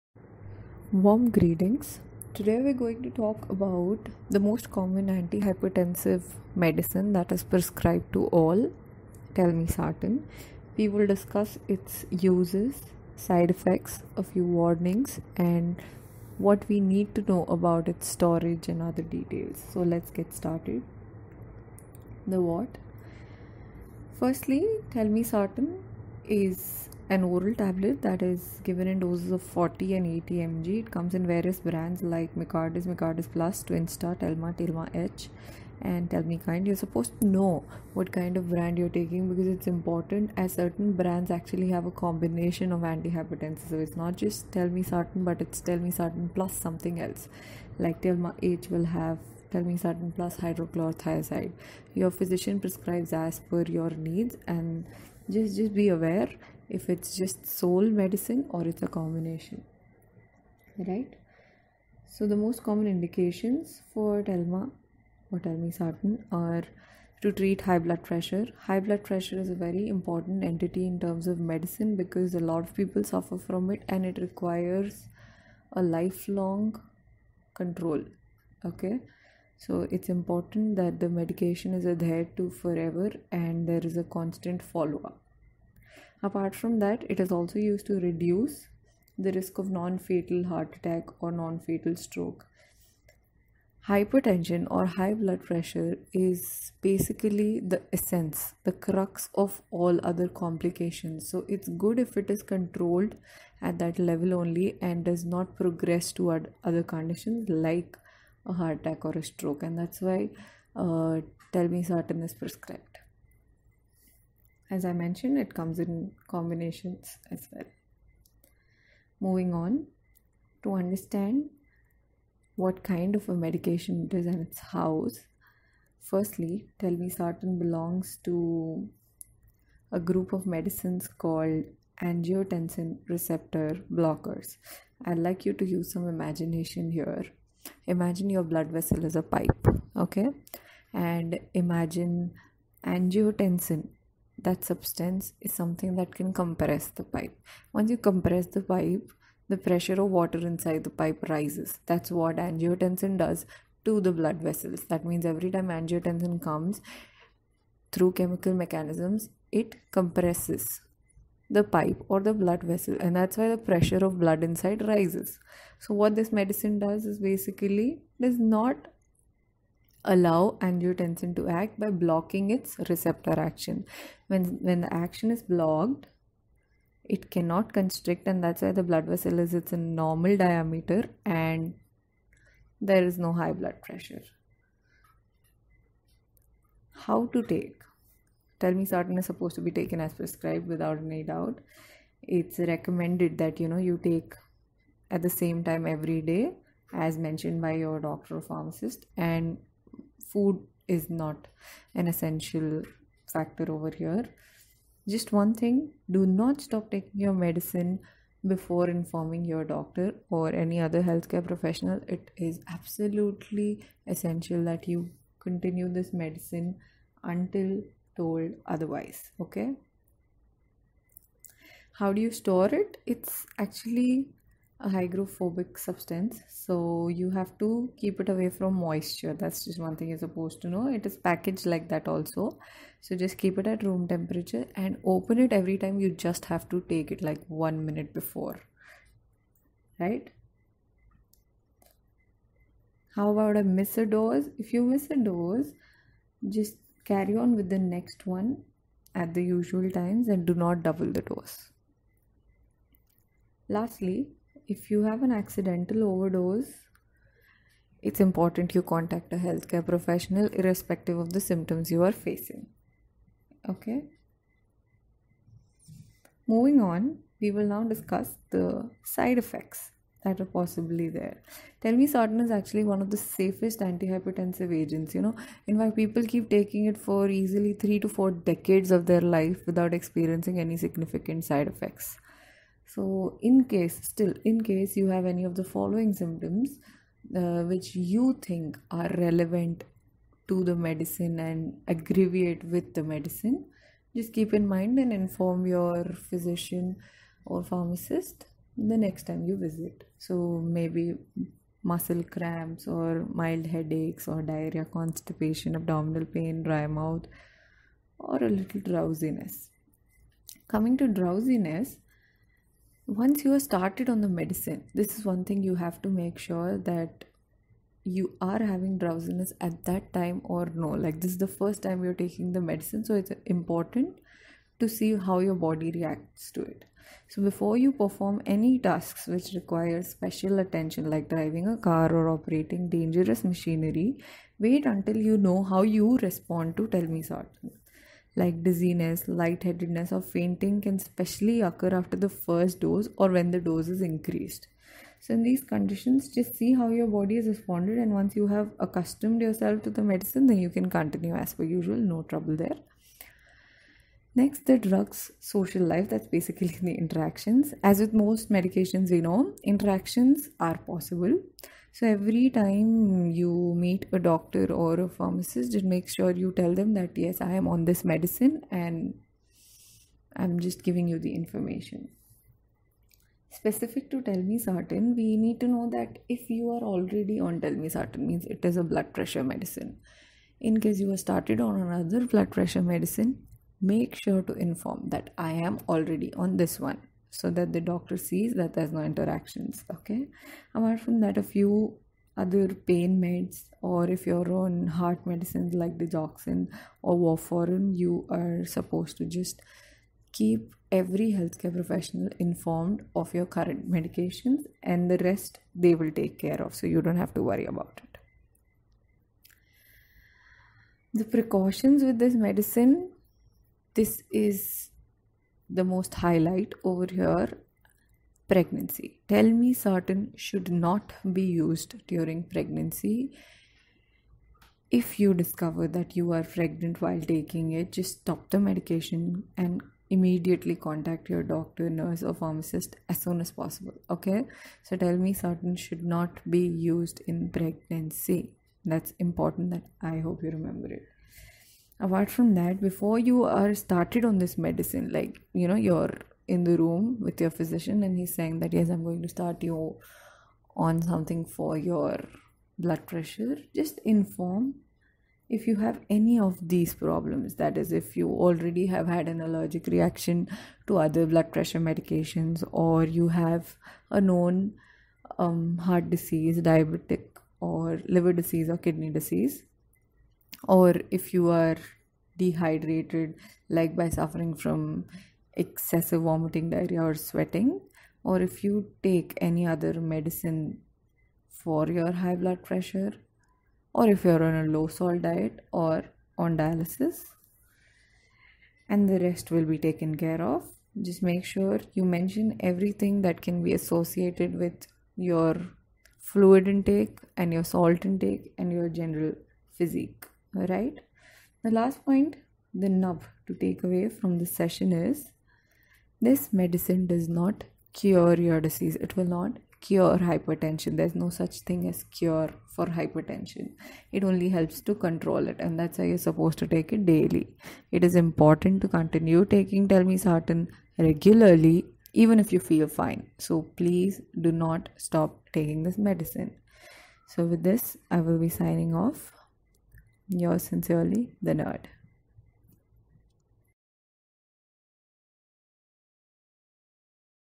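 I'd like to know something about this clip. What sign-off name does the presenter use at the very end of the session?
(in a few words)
The nerd.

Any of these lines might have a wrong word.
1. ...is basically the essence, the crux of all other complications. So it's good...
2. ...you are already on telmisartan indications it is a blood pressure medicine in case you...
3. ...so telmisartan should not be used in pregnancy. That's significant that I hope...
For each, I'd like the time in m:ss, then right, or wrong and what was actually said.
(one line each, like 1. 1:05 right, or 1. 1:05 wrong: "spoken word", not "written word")
1. 1:36 right
2. 6:16 wrong: "means", not "indications"
3. 7:14 wrong: "important", not "significant".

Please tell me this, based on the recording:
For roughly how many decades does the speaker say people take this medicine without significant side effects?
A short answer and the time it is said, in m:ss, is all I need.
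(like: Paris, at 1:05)
3 to 4, at 4:37.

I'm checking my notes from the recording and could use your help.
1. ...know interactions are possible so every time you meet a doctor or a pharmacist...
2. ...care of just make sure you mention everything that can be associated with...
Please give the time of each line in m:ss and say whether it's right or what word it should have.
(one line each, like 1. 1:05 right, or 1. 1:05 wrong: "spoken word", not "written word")
1. 5:59 right
2. 8:10 right.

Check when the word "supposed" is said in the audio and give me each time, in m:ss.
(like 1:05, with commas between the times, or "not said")
0:36, 3:09, 3:50, 6:38, 8:36.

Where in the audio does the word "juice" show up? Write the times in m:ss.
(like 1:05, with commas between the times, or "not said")
not said.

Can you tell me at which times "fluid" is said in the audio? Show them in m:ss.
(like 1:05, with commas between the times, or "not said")
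8:16.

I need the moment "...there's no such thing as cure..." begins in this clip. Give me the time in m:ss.
8:30.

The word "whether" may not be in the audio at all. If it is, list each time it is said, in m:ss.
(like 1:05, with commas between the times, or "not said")
not said.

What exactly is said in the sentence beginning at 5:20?
Like this is the first time you're taking the medicine, so it's important to see how your body reacts to it.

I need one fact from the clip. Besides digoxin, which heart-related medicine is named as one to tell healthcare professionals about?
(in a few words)
Warfarin.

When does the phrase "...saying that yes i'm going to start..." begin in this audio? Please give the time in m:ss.
7:28.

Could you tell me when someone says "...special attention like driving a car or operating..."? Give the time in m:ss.
5:30.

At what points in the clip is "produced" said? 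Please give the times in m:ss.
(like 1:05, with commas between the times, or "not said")
not said.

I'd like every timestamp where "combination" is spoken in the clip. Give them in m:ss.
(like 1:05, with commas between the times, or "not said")
0:41, 0:58, 1:56.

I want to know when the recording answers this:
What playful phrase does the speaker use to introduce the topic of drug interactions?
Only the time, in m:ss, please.
5:54.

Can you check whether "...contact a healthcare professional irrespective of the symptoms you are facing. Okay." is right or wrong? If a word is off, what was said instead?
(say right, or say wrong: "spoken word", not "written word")
right.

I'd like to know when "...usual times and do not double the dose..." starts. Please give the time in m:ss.
4:09.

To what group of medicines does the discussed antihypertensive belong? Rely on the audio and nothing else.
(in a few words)
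Angiotensin receptor blockers.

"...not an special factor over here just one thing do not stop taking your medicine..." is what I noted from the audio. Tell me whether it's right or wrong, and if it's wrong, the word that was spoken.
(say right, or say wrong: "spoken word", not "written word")
wrong: "essential", not "special".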